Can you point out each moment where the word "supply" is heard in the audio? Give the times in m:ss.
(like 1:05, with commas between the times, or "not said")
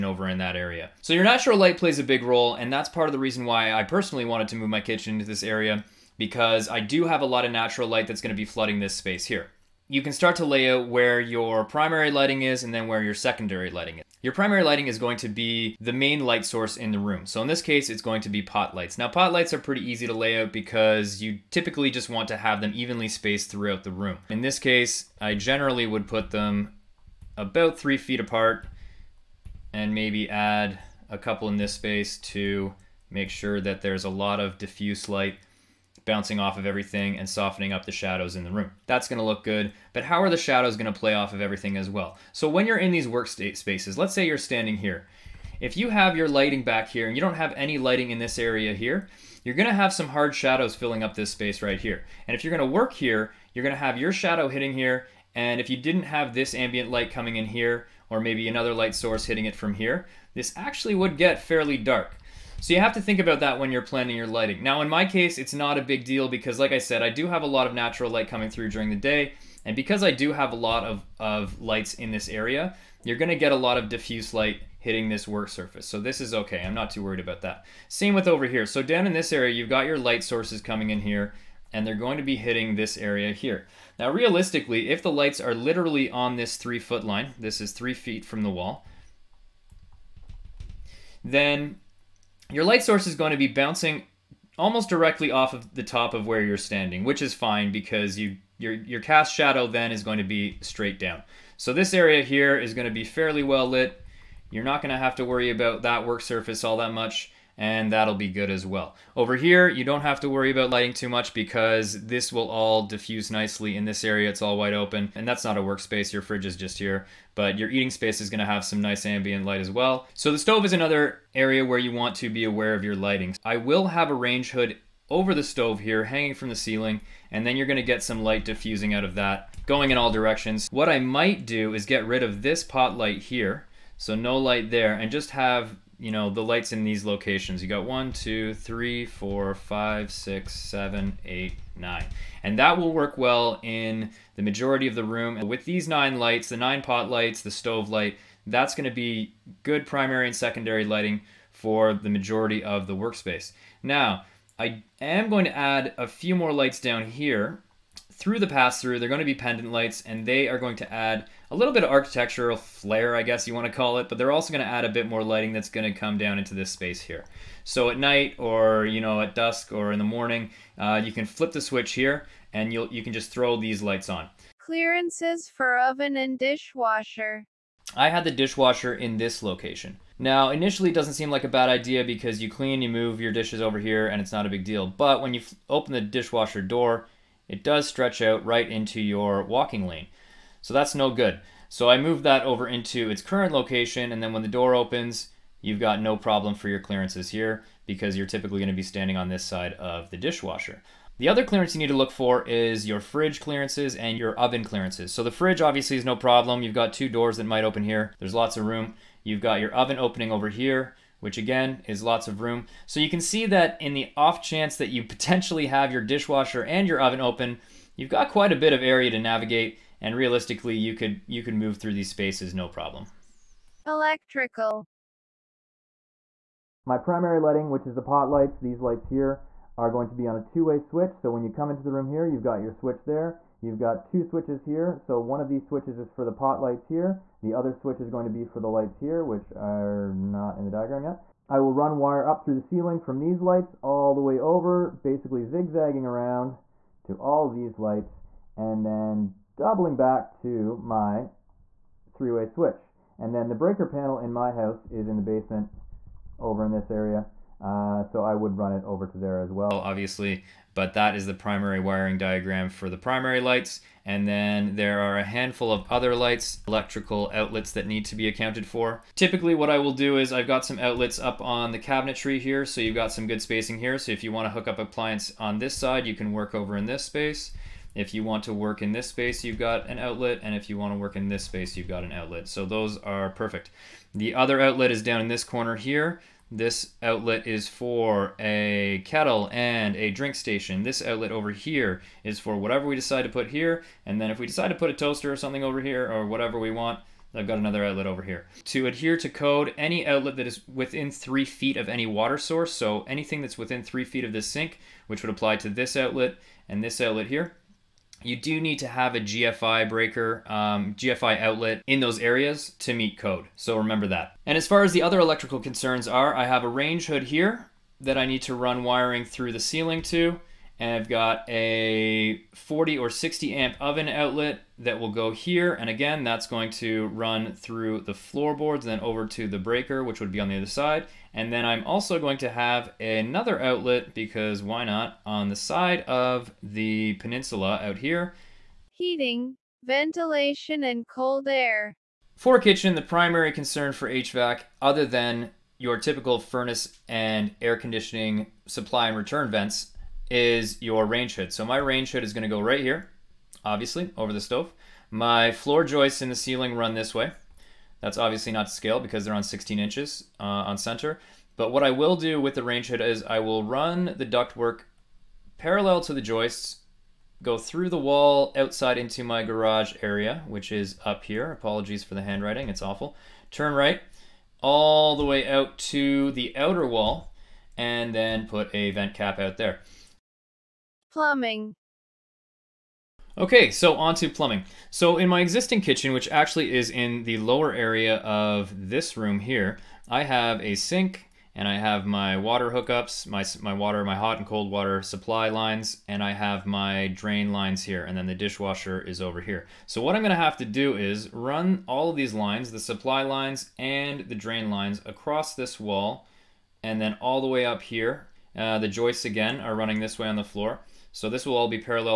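5:48, 6:35, 6:42.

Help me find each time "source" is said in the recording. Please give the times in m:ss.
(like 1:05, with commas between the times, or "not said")
0:16, 0:58, 1:20, 1:32, 5:02.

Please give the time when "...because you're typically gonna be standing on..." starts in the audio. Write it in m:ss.
3:17.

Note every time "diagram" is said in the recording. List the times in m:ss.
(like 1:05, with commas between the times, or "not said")
4:00, 4:22.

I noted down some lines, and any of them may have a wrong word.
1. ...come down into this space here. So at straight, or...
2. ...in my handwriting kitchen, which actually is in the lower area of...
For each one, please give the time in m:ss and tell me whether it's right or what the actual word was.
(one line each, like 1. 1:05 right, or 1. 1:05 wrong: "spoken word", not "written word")
1. 2:45 wrong: "night", not "straight"
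2. 6:25 wrong: "existing", not "handwriting".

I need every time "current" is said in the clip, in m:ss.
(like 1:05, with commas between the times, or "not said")
3:13.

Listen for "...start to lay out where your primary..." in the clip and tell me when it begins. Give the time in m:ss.
0:10.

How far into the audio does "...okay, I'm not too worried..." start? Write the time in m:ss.
1:16.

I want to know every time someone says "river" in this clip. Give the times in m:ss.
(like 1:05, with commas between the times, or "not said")
not said.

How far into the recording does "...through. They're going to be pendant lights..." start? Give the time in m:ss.
2:38.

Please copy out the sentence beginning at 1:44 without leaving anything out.
You're not going to have to worry about that work surface all that much and that'll be good as well.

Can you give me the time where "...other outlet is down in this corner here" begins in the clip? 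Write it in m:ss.
4:44.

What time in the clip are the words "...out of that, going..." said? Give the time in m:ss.
2:08.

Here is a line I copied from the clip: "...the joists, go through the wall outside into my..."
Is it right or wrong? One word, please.
right.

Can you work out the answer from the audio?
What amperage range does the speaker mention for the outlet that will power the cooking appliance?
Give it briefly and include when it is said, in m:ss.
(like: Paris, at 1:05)
40 or 60 amp, at 5:22.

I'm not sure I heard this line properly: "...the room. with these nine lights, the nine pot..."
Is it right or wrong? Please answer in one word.
right.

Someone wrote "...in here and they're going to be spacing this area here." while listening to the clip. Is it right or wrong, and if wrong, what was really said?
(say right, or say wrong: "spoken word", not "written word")
wrong: "hitting", not "spacing".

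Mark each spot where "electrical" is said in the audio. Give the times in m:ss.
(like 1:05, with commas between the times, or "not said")
3:43, 4:26, 5:15.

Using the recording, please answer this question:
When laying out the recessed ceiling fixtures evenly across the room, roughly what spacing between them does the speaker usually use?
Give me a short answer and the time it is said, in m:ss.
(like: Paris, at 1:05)
3 feet apart, at 0:27.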